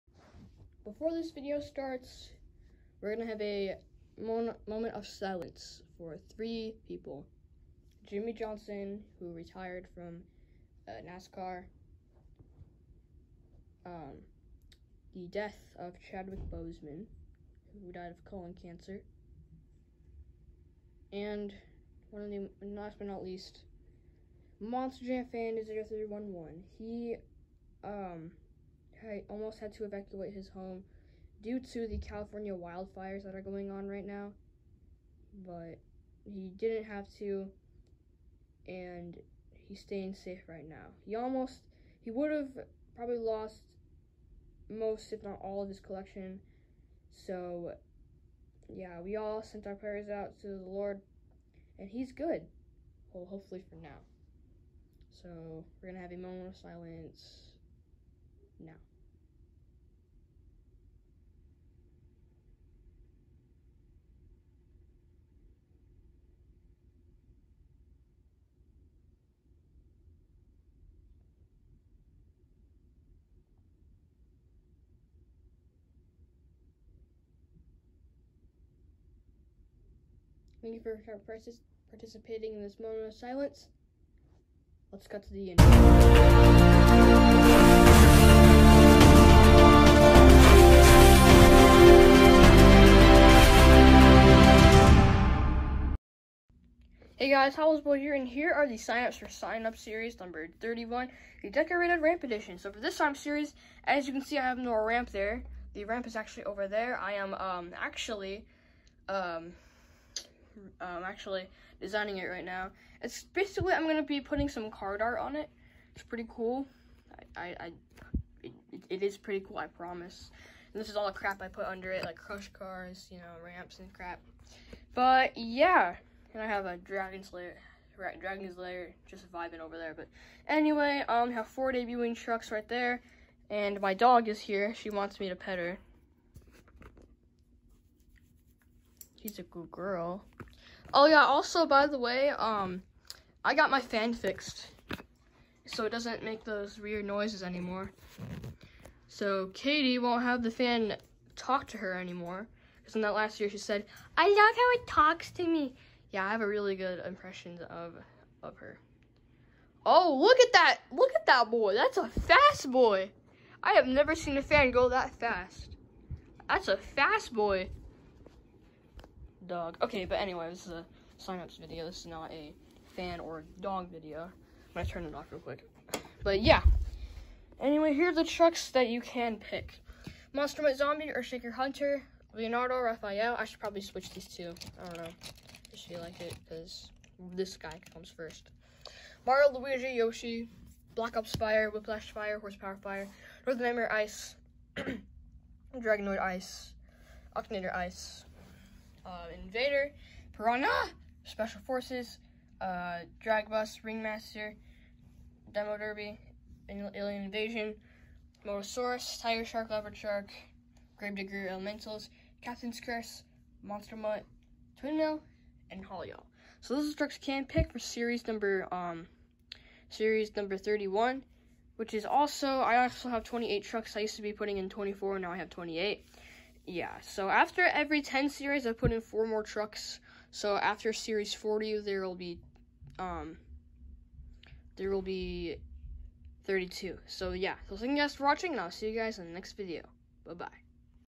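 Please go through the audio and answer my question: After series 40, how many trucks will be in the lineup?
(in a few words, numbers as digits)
32.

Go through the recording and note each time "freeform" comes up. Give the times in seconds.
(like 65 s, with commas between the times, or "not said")
not said.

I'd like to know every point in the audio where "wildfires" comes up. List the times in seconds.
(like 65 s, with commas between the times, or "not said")
32 s.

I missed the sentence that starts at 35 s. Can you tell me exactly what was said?
But he didn't have to, and he's staying safe right now.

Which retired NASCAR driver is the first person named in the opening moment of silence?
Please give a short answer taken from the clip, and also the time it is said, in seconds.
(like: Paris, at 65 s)
Jimmie Johnson, at 8 s.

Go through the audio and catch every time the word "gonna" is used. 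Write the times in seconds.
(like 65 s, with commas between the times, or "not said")
3 s, 174 s.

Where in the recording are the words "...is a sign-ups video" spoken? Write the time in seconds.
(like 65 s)
170 s.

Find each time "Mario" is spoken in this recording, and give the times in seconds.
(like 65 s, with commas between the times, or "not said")
189 s.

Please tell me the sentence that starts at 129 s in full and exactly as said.
But anyway, um, have four debuting trucks right there.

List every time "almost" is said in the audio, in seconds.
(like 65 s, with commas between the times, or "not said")
29 s, 41 s.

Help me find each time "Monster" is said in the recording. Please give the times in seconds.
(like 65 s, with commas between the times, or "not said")
24 s, 180 s, 213 s.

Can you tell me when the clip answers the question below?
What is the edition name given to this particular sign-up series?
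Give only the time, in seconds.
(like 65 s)
101 s.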